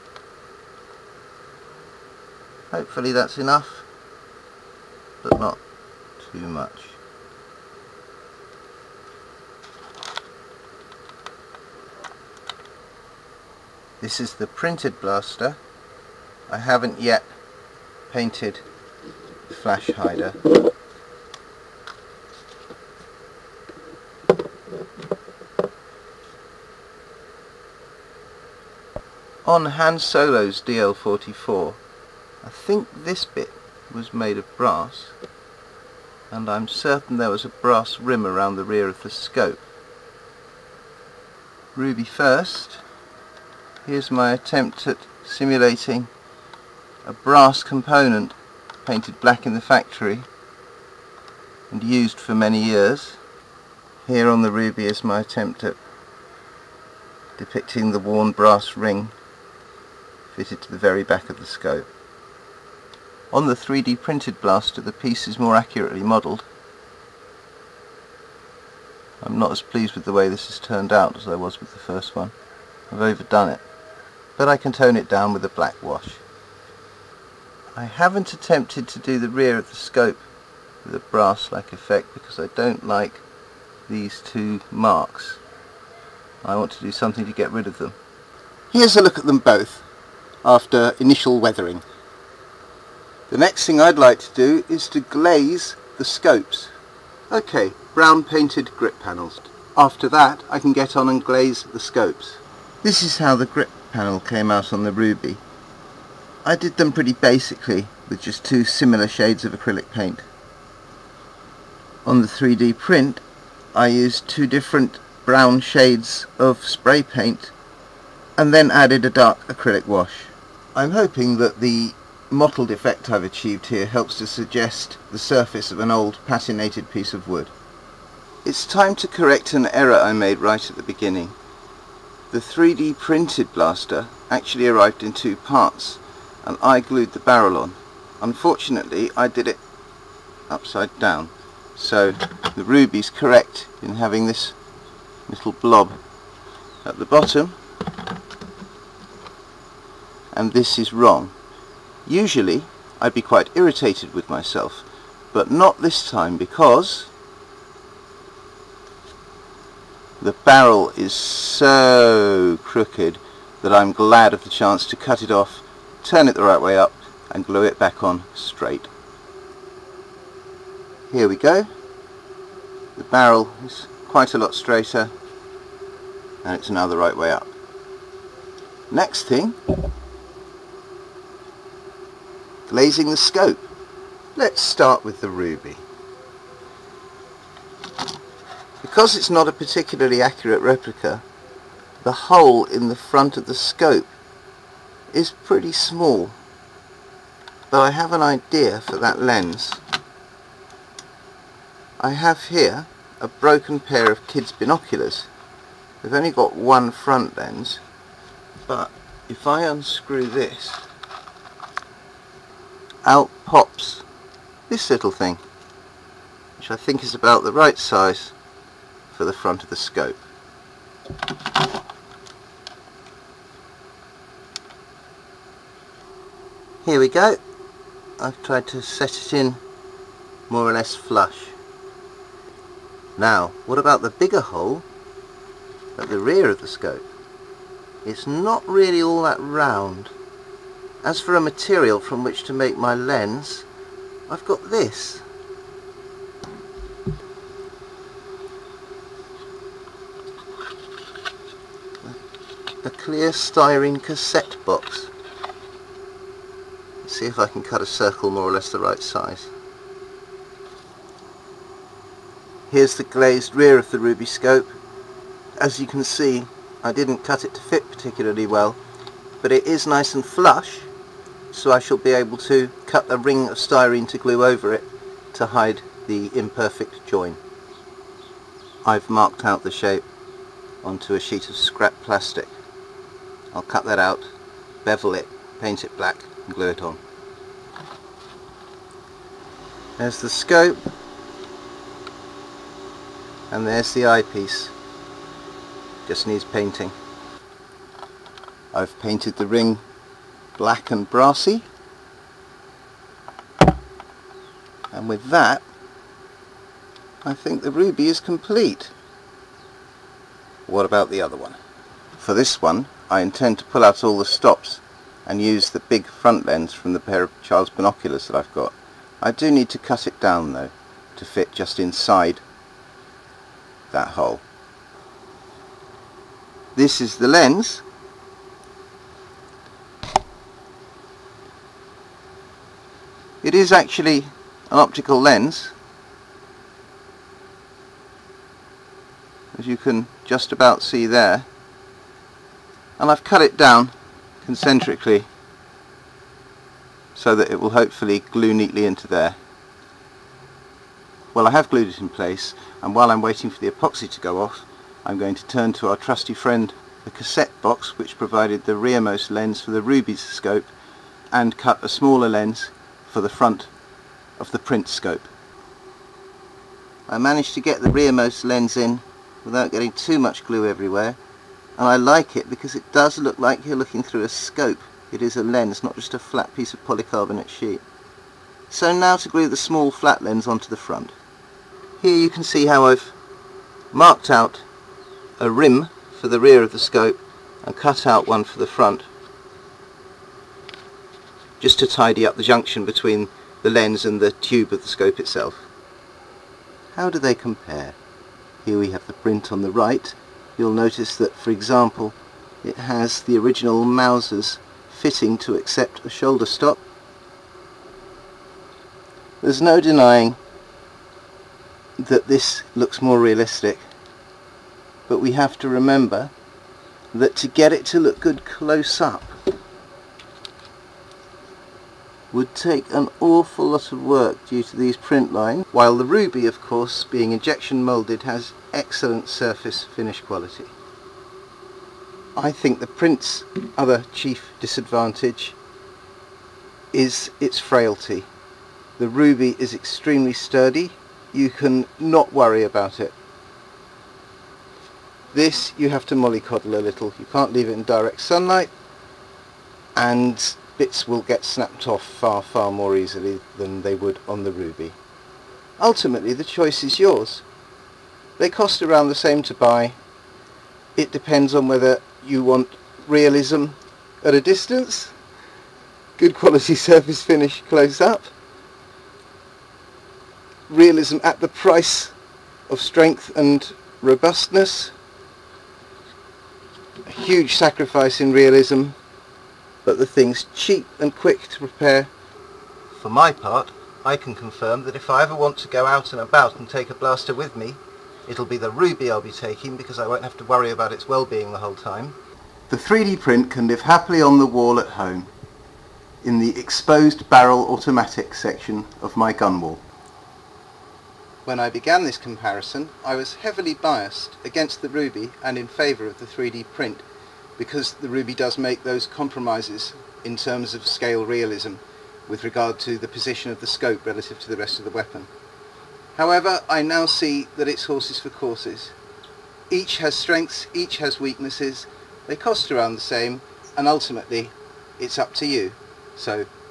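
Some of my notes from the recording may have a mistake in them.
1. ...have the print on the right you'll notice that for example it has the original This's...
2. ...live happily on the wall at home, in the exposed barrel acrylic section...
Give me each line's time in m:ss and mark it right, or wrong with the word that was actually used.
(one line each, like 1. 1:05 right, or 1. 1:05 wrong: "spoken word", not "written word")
1. 6:38 wrong: "Mauser", not "This"
2. 8:13 wrong: "automatic", not "acrylic".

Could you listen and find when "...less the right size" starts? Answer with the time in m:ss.
4:18.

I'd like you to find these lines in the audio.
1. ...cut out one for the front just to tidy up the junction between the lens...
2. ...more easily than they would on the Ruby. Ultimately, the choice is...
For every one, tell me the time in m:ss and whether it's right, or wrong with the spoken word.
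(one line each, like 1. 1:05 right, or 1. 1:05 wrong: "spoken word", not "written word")
1. 6:27 right
2. 7:32 right.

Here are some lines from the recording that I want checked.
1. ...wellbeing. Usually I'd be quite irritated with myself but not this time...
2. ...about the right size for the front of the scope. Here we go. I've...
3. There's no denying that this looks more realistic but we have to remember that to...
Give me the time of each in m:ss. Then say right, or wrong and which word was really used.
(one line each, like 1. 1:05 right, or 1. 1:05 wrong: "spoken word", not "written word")
1. 2:30 wrong: "wrong", not "wellbeing"
2. 3:37 right
3. 6:49 right.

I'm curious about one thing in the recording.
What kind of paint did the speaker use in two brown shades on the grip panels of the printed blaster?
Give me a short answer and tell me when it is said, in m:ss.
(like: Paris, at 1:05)
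spray paint, at 1:56.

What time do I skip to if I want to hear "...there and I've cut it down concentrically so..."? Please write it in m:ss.
5:41.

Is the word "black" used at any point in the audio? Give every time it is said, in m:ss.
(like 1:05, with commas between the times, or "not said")
0:49, 1:15, 4:45, 5:00.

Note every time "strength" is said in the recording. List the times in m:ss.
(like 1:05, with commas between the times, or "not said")
7:52, 8:40.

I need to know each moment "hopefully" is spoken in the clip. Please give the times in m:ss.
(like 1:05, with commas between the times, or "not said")
0:02, 5:47.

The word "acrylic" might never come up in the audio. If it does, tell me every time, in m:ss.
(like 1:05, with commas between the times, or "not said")
1:49, 1:59.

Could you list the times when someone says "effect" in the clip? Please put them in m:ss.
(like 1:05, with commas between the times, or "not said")
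1:21, 2:02.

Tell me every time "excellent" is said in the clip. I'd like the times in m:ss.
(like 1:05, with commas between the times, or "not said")
7:08.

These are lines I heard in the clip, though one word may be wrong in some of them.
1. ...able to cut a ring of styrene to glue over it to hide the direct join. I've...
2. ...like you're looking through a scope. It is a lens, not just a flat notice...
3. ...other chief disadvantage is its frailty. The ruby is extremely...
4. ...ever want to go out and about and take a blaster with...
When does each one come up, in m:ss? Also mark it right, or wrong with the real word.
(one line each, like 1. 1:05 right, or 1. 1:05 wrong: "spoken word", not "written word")
1. 4:32 wrong: "imperfect", not "direct"
2. 6:13 wrong: "piece", not "notice"
3. 7:13 right
4. 8:05 right.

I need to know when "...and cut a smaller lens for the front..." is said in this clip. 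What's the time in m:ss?
6:01.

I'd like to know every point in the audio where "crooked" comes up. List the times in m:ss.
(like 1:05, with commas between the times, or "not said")
2:42.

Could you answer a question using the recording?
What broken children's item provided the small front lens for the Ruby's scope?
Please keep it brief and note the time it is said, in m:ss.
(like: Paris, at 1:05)
kids binoculars, at 3:24.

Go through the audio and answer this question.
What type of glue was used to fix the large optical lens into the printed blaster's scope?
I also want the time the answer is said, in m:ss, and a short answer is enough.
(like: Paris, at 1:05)
epoxy, at 5:53.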